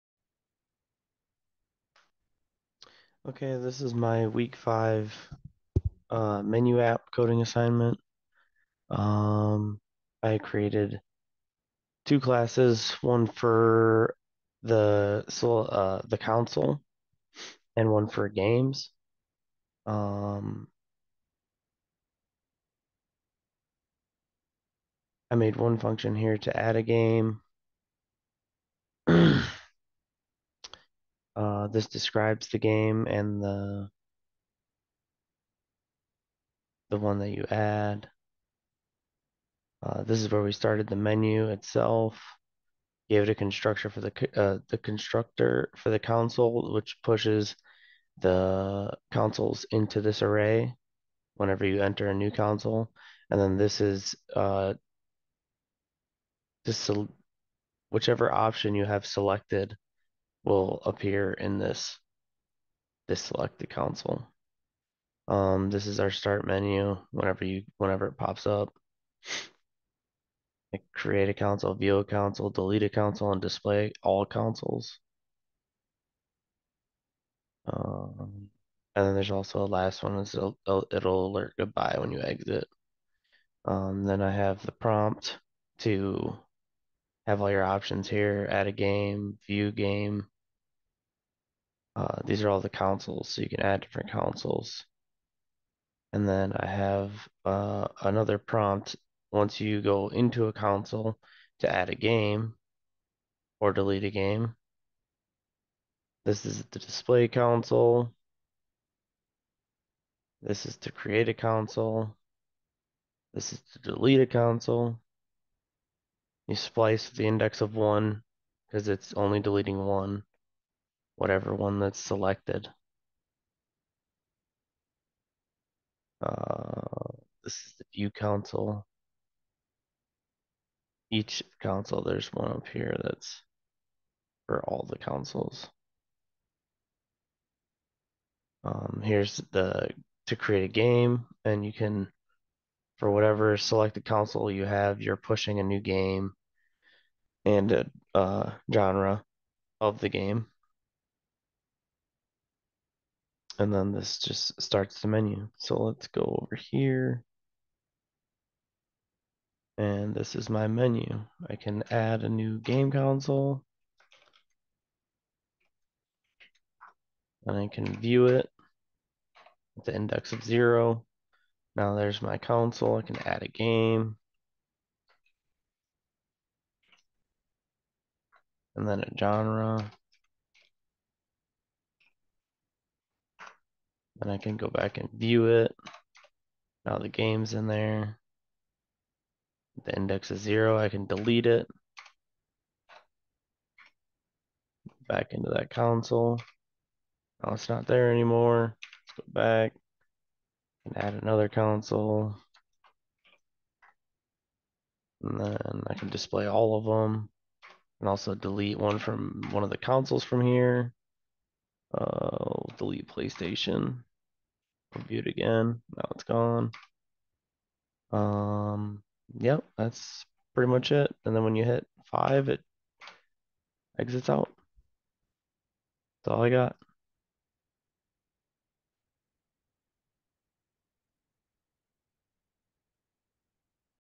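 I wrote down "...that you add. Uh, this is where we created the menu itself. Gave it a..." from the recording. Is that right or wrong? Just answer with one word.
wrong.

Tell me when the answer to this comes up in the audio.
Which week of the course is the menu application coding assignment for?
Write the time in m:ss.
0:04.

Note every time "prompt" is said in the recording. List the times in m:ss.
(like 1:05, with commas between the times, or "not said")
1:24, 1:38.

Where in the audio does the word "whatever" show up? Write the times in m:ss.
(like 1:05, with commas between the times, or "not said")
2:01, 2:23.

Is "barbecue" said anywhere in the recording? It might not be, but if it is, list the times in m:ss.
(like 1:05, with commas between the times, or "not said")
not said.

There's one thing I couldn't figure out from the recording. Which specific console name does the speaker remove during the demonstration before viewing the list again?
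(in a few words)
PlayStation.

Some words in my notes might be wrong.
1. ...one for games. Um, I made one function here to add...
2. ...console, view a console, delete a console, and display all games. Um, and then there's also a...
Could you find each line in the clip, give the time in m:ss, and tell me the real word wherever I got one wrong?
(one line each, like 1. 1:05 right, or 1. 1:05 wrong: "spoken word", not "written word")
1. 0:17 right
2. 1:11 wrong: "consoles", not "games".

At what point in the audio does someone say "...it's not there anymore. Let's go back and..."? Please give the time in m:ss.
3:17.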